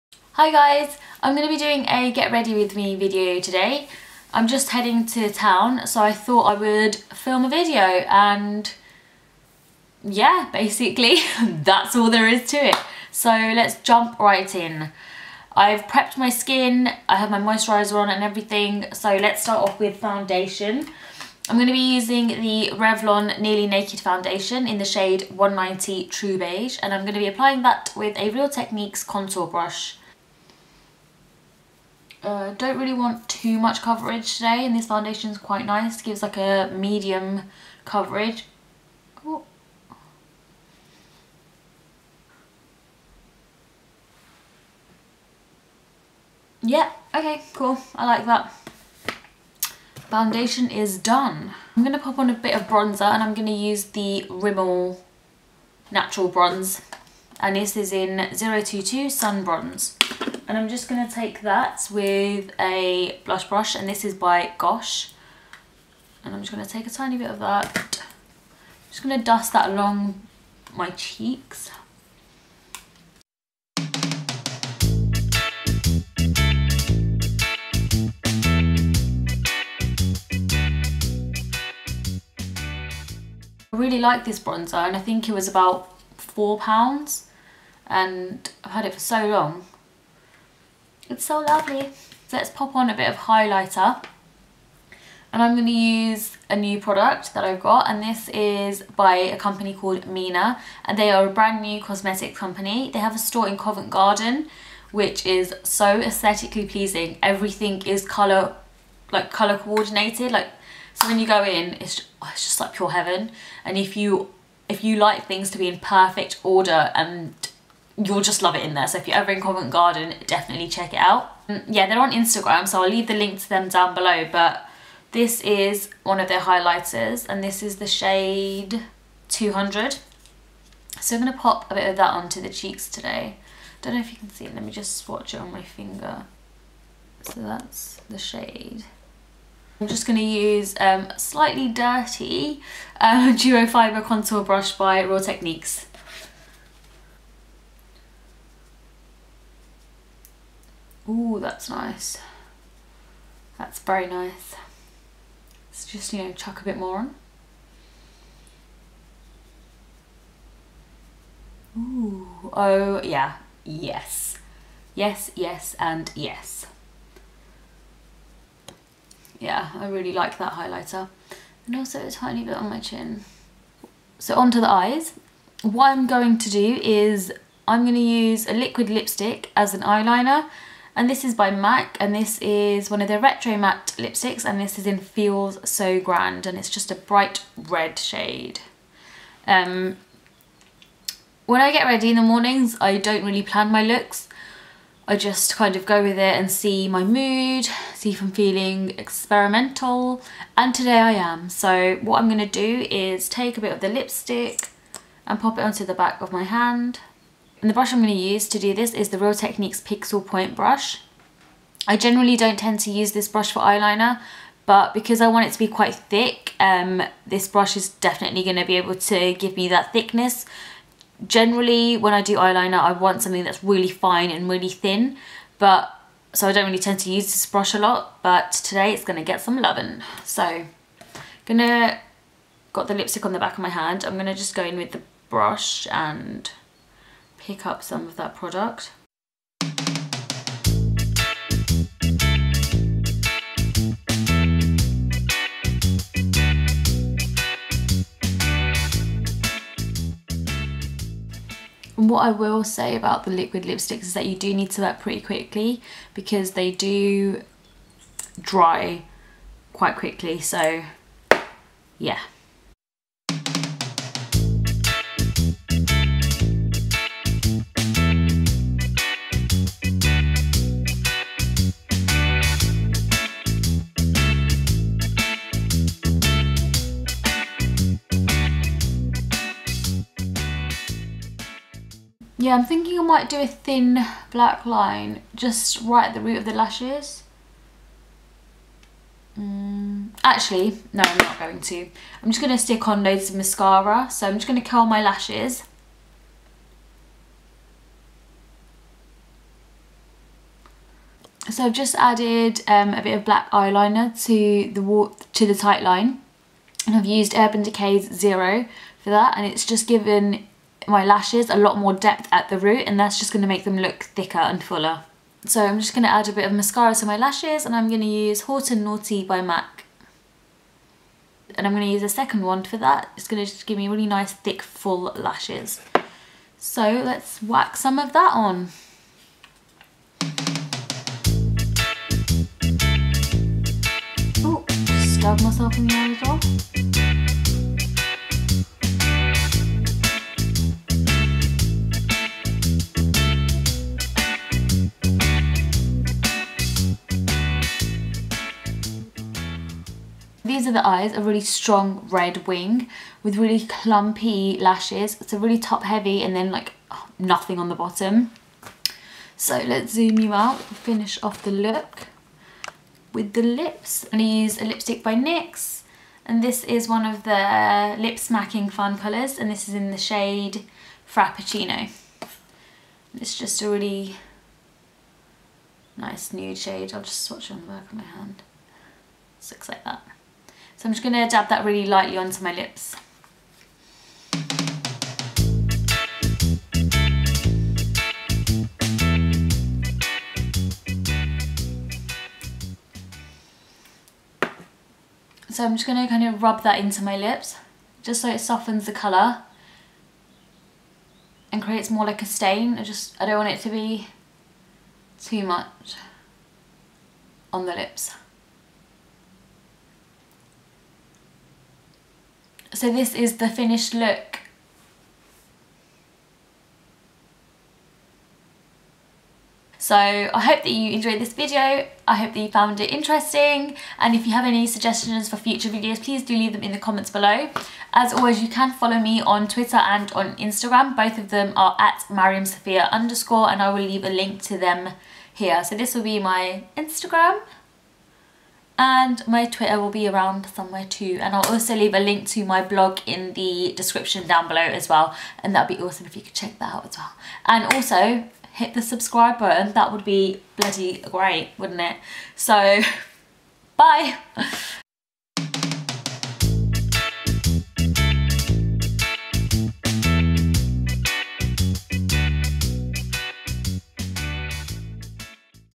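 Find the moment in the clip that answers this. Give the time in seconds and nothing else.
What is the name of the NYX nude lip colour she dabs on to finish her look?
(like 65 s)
371 s.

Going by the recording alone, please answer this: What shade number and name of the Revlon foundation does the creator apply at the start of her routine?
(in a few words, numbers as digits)
190 True Beige.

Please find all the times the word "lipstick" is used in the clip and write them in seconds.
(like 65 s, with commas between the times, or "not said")
178 s, 183 s, 203 s, 232 s, 253 s, 364 s.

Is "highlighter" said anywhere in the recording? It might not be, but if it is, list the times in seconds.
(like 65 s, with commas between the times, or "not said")
93 s, 126 s, 170 s.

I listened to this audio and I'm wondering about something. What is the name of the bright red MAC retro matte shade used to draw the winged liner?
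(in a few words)
Feels So Grand.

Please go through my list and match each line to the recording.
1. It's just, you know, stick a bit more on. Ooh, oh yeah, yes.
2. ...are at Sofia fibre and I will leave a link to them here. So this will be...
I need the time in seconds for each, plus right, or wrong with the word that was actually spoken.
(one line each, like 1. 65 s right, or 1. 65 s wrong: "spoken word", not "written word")
1. 155 s wrong: "chuck", not "stick"
2. 431 s wrong: "underscore", not "fibre".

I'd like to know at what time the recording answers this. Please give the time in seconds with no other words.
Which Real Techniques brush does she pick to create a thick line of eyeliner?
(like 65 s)
209 s.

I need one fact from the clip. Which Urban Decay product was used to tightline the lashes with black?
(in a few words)
Zero.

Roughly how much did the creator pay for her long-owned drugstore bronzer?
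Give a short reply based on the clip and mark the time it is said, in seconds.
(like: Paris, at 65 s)
£4, at 85 s.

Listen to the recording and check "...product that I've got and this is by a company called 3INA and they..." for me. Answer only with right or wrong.
right.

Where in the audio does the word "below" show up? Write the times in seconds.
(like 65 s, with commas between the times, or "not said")
123 s, 427 s, 444 s.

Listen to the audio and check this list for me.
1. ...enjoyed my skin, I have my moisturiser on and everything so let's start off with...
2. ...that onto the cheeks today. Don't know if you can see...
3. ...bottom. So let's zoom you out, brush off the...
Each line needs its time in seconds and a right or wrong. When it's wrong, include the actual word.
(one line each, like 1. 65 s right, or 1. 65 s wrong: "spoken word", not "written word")
1. 15 s wrong: "prepped", not "enjoyed"
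2. 131 s right
3. 357 s wrong: "finish", not "brush".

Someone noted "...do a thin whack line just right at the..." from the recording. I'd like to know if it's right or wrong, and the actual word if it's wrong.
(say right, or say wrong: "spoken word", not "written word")
wrong: "black", not "whack".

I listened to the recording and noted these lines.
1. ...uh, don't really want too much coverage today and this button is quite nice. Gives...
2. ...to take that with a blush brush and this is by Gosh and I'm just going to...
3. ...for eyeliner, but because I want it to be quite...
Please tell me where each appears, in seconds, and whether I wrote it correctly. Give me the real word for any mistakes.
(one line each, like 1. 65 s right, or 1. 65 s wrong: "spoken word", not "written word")
1. 32 s wrong: "foundation", not "button"
2. 61 s right
3. 213 s right.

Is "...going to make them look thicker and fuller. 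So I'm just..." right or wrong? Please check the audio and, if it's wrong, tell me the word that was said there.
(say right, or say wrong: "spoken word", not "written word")
right.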